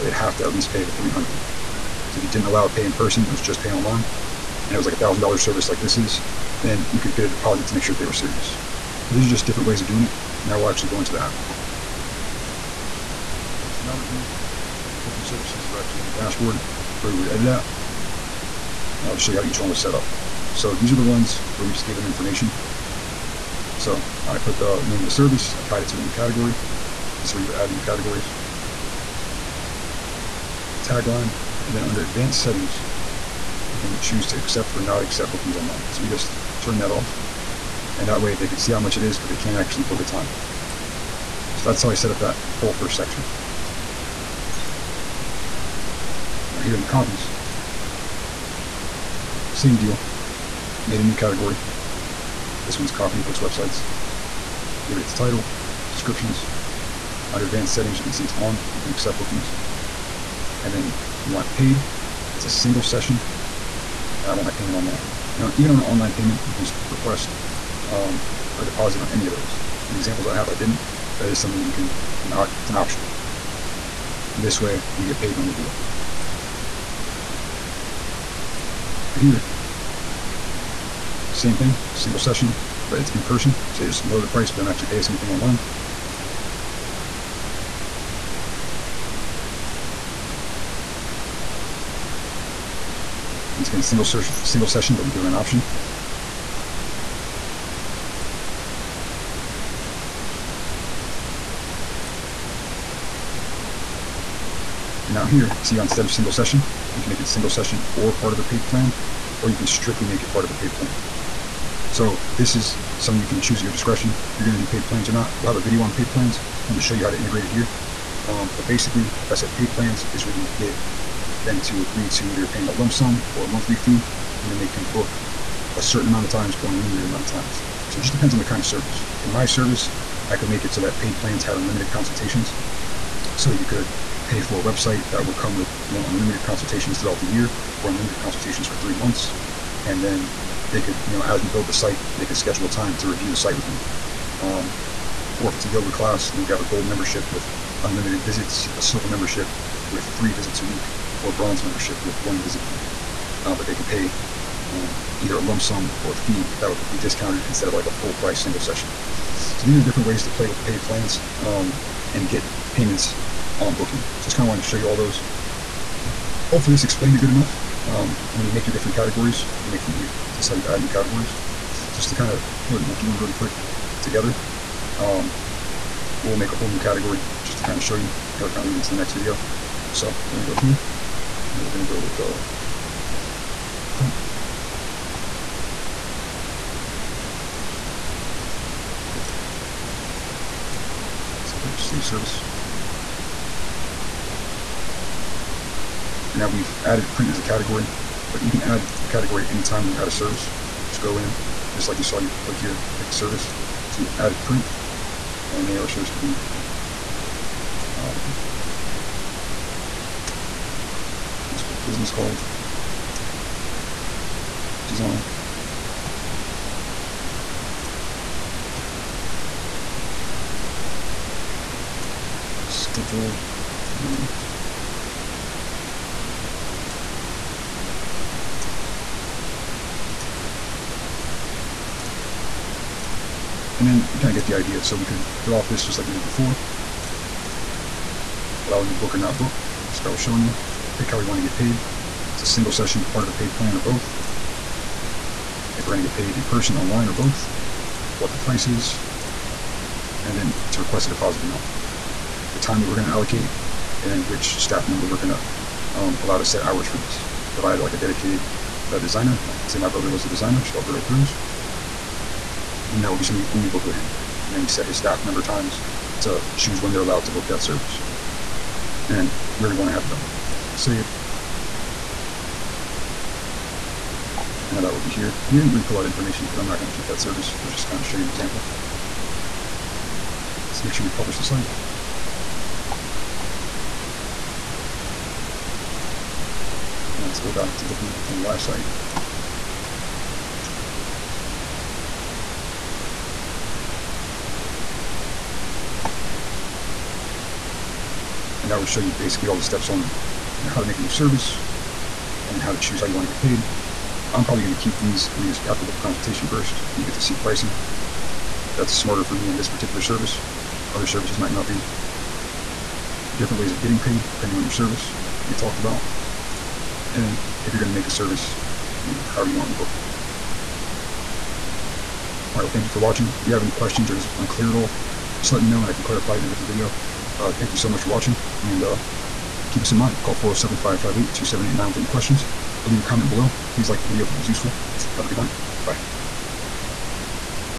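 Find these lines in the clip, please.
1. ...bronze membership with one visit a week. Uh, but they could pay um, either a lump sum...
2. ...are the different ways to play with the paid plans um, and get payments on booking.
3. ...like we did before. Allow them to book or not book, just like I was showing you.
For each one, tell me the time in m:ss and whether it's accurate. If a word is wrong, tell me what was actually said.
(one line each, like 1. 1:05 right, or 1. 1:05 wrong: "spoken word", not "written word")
1. 2:31 right
2. 2:39 right
3. 3:55 right.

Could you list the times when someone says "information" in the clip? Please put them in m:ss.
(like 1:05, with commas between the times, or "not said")
0:22, 4:36.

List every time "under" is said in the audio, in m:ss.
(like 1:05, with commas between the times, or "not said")
0:31, 0:57.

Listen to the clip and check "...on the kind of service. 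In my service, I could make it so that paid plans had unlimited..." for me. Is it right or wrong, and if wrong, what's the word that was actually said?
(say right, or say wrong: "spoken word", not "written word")
right.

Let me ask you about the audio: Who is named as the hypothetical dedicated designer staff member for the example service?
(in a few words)
Alberto Cruz.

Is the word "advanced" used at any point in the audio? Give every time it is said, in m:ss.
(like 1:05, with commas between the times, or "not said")
0:32, 0:57.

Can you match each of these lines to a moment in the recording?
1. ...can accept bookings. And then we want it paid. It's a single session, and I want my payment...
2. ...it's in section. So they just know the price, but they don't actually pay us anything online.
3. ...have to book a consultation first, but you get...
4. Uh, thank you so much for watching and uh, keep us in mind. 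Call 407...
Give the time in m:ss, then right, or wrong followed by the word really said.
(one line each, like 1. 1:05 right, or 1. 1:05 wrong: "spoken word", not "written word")
1. 0:58 right
2. 1:22 wrong: "person", not "section"
3. 5:05 right
4. 5:27 right.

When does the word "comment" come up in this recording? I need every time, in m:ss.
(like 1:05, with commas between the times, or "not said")
5:33.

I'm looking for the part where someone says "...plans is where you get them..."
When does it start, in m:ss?
1:59.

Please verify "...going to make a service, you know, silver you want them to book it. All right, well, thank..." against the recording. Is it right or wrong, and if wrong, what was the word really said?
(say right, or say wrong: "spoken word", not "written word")
wrong: "however", not "silver".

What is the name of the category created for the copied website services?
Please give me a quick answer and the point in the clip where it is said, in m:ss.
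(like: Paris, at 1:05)
Copy of Wix websites, at 0:52.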